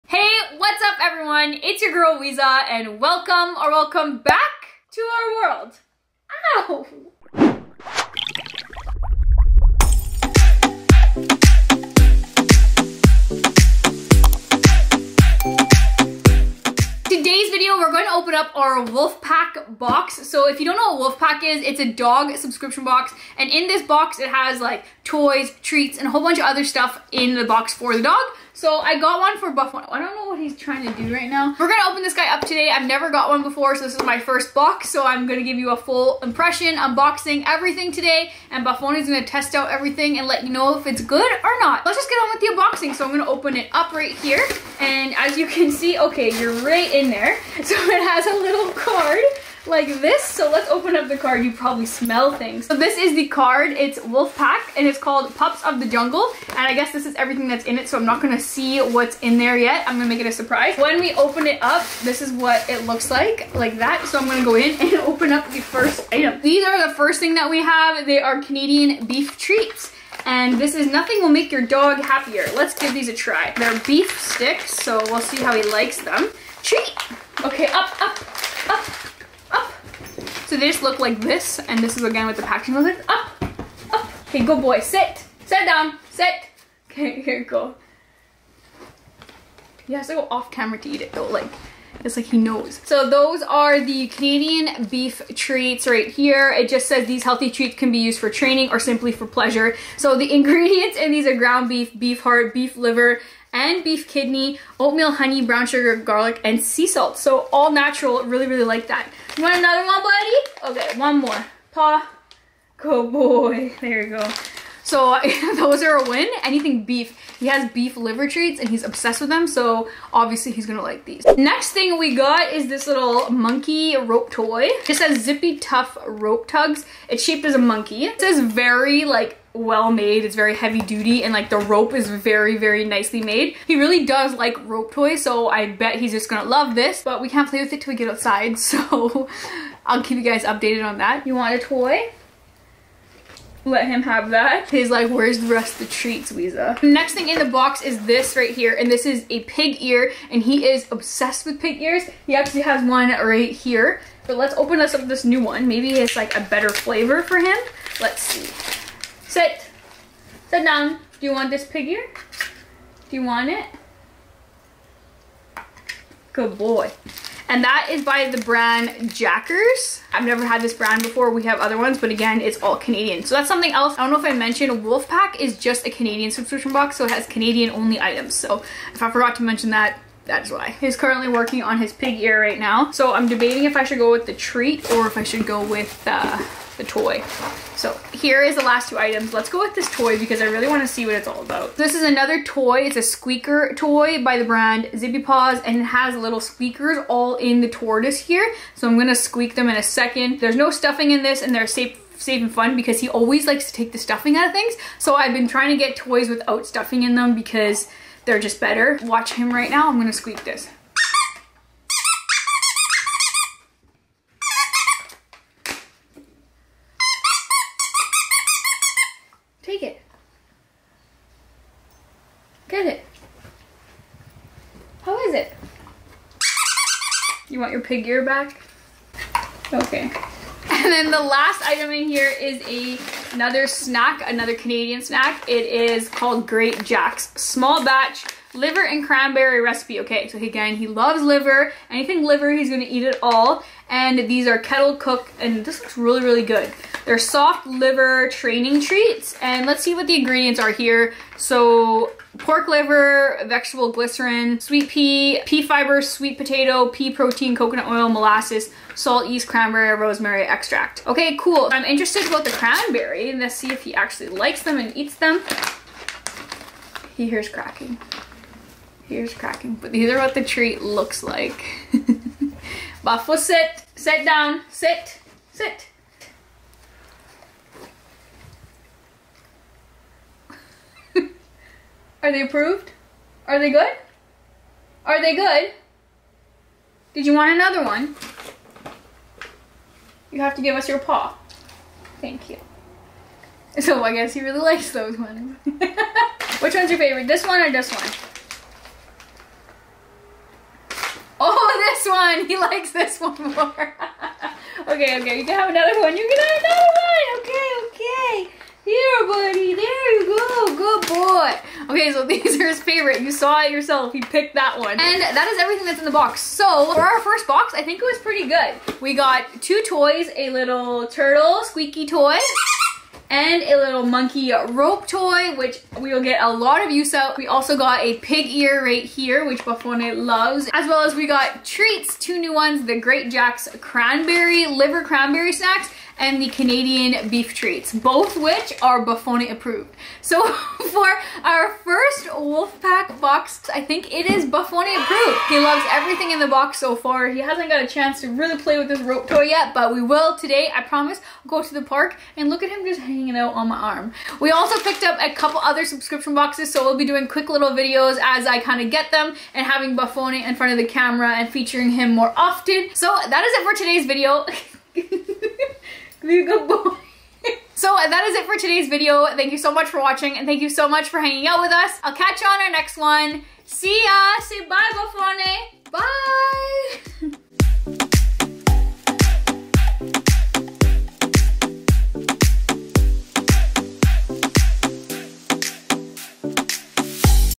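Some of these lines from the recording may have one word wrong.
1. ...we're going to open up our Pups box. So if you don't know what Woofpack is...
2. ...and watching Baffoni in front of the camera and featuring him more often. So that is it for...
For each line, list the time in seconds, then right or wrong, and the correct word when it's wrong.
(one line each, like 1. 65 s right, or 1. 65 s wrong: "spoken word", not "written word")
1. 17 s wrong: "Woofpack", not "Pups"
2. 359 s wrong: "having", not "watching".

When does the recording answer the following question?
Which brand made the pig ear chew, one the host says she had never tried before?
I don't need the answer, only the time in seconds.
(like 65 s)
169 s.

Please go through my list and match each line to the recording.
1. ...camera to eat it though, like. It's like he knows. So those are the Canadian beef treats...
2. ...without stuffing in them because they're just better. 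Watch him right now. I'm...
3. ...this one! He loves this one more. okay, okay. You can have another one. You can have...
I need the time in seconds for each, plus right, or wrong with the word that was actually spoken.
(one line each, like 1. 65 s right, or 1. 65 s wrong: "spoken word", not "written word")
1. 90 s right
2. 206 s right
3. 301 s wrong: "likes", not "loves".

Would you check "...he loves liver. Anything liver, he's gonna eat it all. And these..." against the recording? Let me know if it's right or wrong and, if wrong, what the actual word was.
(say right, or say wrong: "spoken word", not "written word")
right.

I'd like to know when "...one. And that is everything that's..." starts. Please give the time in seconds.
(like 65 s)
314 s.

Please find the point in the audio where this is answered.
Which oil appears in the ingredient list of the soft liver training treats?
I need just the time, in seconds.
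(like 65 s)
257 s.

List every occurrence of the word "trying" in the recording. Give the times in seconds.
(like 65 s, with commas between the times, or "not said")
30 s, 205 s.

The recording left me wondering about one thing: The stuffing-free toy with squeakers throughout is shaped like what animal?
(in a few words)
Tortoise.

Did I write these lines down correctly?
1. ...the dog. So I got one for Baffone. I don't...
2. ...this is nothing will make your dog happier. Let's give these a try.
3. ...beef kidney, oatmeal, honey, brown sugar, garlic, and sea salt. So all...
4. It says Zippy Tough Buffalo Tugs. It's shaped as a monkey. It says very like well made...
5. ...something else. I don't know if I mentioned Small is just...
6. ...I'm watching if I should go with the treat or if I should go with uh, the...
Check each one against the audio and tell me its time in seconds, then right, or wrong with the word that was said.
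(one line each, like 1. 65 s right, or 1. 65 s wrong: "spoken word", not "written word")
1. 27 s right
2. 70 s right
3. 103 s right
4. 124 s wrong: "Rope", not "Buffalo"
5. 173 s wrong: "Woofpack", not "Small"
6. 183 s wrong: "debating", not "watching".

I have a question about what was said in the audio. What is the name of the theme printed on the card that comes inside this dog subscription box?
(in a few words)
Pups of the Jungle.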